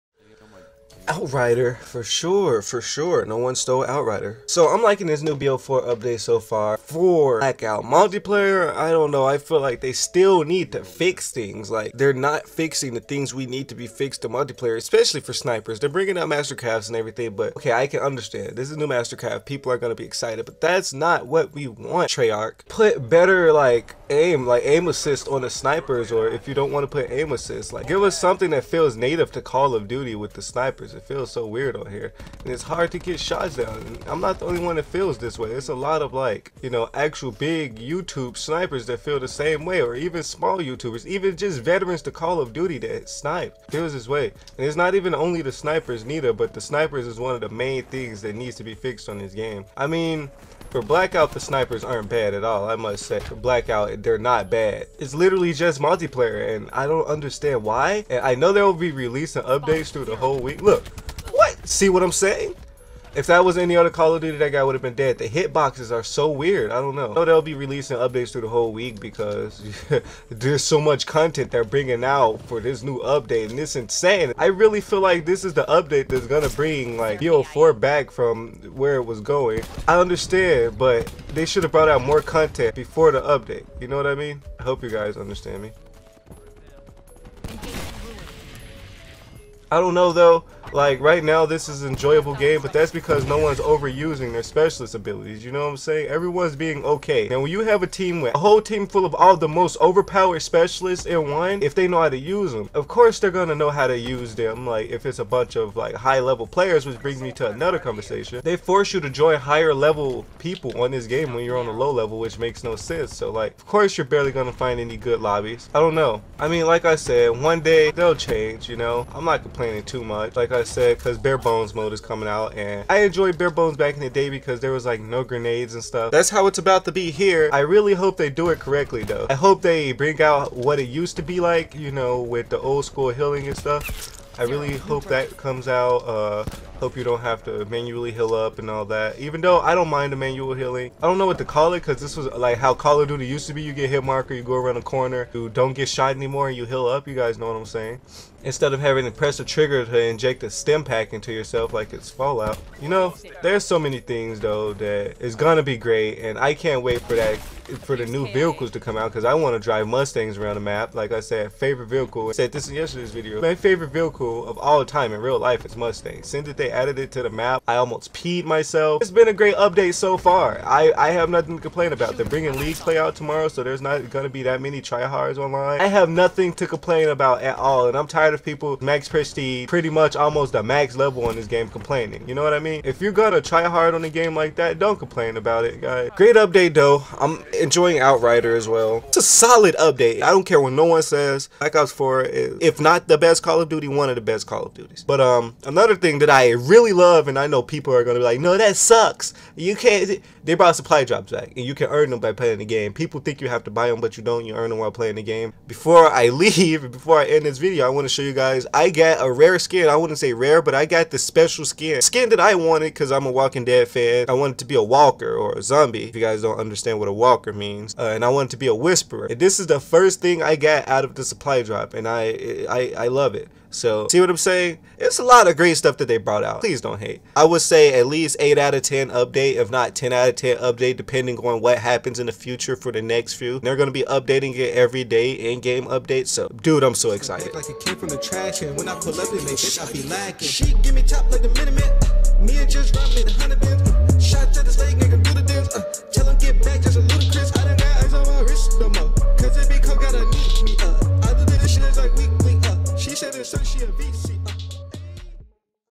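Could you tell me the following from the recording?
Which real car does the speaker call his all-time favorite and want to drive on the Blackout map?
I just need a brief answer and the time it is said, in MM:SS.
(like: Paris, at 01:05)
Mustang, at 02:45.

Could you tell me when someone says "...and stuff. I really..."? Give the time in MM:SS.
02:13.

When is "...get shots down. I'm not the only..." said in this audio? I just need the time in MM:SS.
00:32.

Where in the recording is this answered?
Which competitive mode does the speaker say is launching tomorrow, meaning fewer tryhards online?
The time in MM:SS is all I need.
02:52.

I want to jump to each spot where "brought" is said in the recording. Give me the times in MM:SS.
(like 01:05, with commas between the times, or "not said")
01:21, 03:20, 03:46.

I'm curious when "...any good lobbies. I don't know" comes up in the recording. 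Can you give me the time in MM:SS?
01:54.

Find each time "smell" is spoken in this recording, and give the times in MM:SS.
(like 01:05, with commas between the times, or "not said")
not said.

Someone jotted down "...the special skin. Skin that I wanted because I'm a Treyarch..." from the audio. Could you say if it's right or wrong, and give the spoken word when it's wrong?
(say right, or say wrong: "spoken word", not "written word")
wrong: "Walking", not "Treyarch".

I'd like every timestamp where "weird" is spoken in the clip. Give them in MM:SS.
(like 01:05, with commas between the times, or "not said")
00:31, 01:06.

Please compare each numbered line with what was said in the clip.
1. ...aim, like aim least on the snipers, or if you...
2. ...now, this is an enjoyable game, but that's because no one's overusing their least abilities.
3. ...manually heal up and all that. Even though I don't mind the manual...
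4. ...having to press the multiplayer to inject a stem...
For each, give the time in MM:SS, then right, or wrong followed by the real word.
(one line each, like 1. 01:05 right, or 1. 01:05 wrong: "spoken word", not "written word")
1. 00:24 wrong: "assist", not "least"
2. 01:31 wrong: "specialist", not "least"
3. 02:17 right
4. 02:28 wrong: "trigger", not "multiplayer".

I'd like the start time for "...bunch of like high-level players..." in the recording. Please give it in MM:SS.
01:45.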